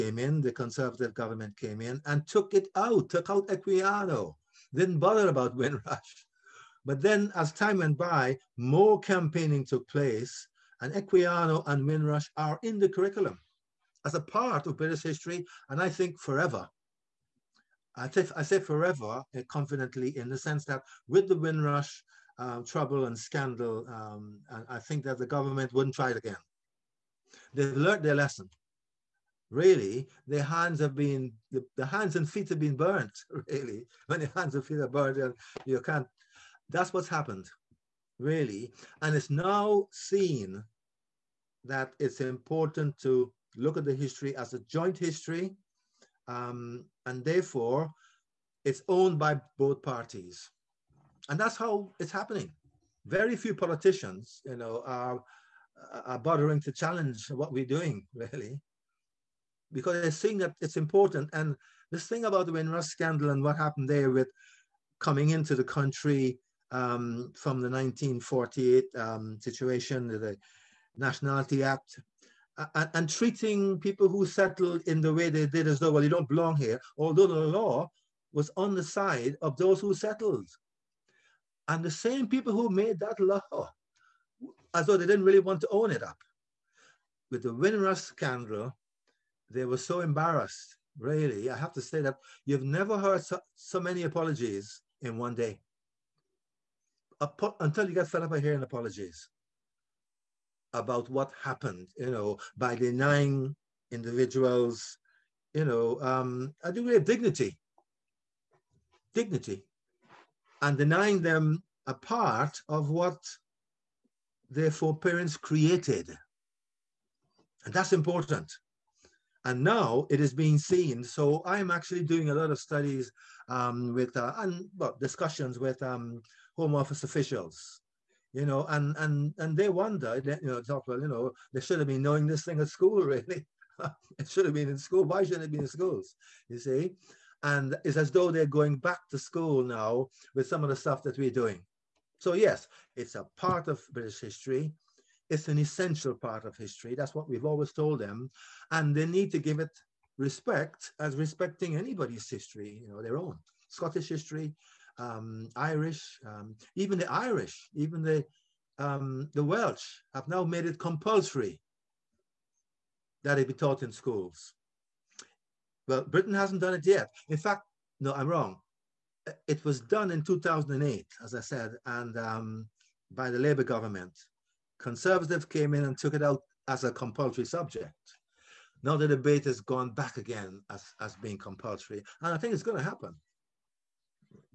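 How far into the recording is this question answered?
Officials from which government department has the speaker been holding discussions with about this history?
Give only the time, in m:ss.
2:06.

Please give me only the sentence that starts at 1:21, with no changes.
And the same people who made that law, as though they didn't really want to own it up.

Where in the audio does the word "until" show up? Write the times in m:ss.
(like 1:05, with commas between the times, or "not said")
1:37.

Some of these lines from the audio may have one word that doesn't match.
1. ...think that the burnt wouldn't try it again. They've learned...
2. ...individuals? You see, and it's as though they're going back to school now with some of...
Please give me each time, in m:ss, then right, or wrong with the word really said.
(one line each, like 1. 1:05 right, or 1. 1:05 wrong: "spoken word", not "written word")
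1. 0:24 wrong: "government", not "burnt"
2. 2:15 wrong: "schools", not "individuals".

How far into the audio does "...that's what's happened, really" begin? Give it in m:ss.
0:36.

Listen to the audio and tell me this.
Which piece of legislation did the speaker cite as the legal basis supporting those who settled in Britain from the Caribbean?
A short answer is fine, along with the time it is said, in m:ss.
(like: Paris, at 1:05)
The Nationality Act, at 1:10.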